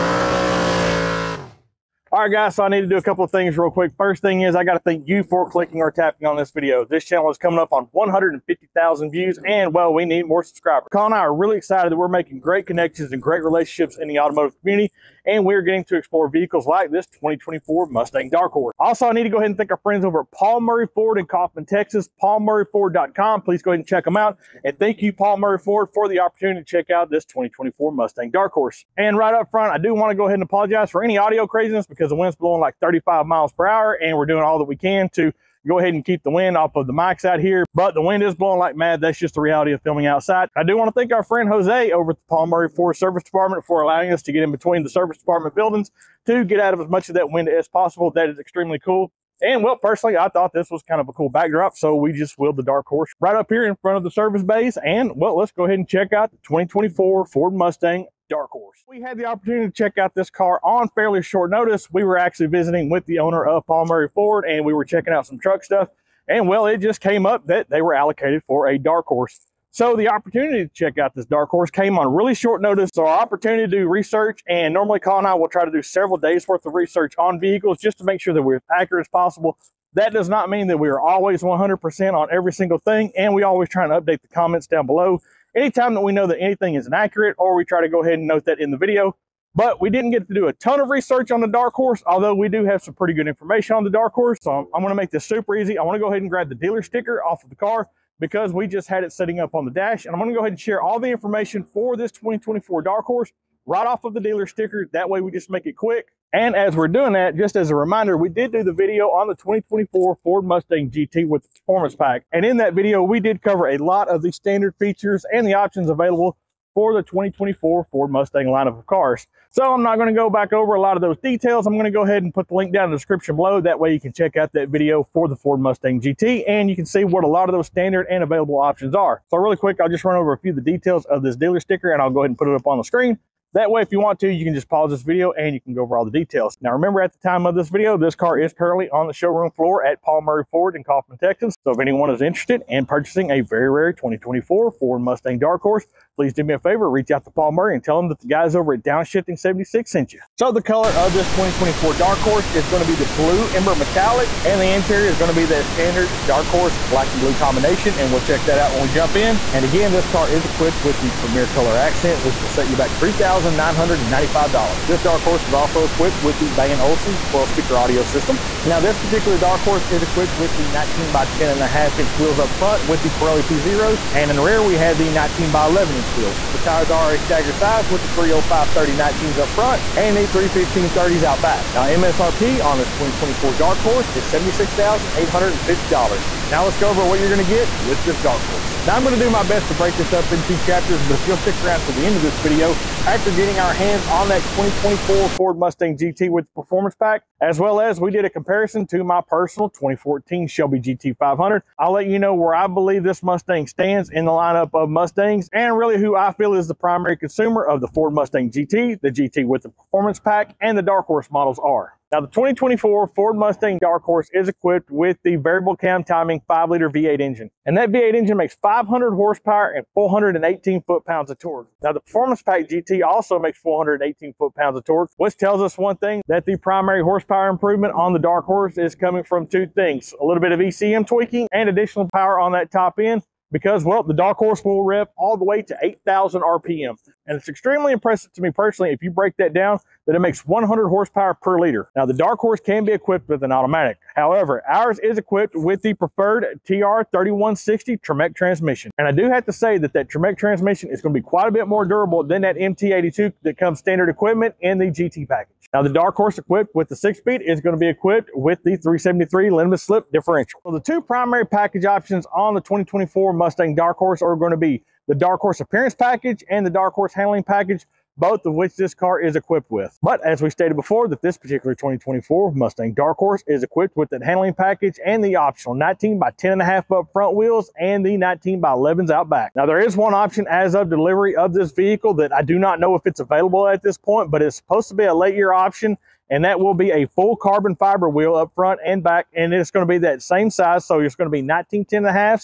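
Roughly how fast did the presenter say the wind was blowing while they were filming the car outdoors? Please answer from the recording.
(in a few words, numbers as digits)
35 mph.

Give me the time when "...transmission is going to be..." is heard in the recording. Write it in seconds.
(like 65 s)
250 s.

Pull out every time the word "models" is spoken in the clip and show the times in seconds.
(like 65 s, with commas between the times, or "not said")
211 s.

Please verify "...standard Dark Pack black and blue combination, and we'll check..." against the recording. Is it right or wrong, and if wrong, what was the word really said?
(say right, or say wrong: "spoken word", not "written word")
wrong: "Horse", not "Pack".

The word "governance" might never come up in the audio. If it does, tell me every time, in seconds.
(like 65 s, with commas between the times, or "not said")
not said.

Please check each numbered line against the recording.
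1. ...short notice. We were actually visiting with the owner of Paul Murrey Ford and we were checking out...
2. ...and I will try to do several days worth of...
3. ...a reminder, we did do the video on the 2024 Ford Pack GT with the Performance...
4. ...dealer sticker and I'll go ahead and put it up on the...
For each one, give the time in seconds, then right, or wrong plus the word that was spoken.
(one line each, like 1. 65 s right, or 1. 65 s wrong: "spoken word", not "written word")
1. 61 s right
2. 75 s right
3. 107 s wrong: "Mustang", not "Pack"
4. 131 s right.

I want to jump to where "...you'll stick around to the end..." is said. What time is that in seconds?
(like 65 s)
191 s.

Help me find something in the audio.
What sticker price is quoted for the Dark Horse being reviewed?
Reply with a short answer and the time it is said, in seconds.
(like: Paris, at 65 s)
$76,850, at 184 s.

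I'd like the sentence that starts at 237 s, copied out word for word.
And it's extremely impressive to me personally, if you break that down, that it makes 100 horsepower per liter.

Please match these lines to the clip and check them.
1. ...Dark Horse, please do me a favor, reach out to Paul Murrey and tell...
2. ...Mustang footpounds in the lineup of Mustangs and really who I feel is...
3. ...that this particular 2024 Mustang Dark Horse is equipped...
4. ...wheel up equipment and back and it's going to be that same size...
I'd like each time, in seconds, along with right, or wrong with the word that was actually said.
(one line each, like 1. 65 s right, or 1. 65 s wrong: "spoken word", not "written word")
1. 145 s right
2. 203 s wrong: "stands", not "footpounds"
3. 271 s right
4. 288 s wrong: "front", not "equipment".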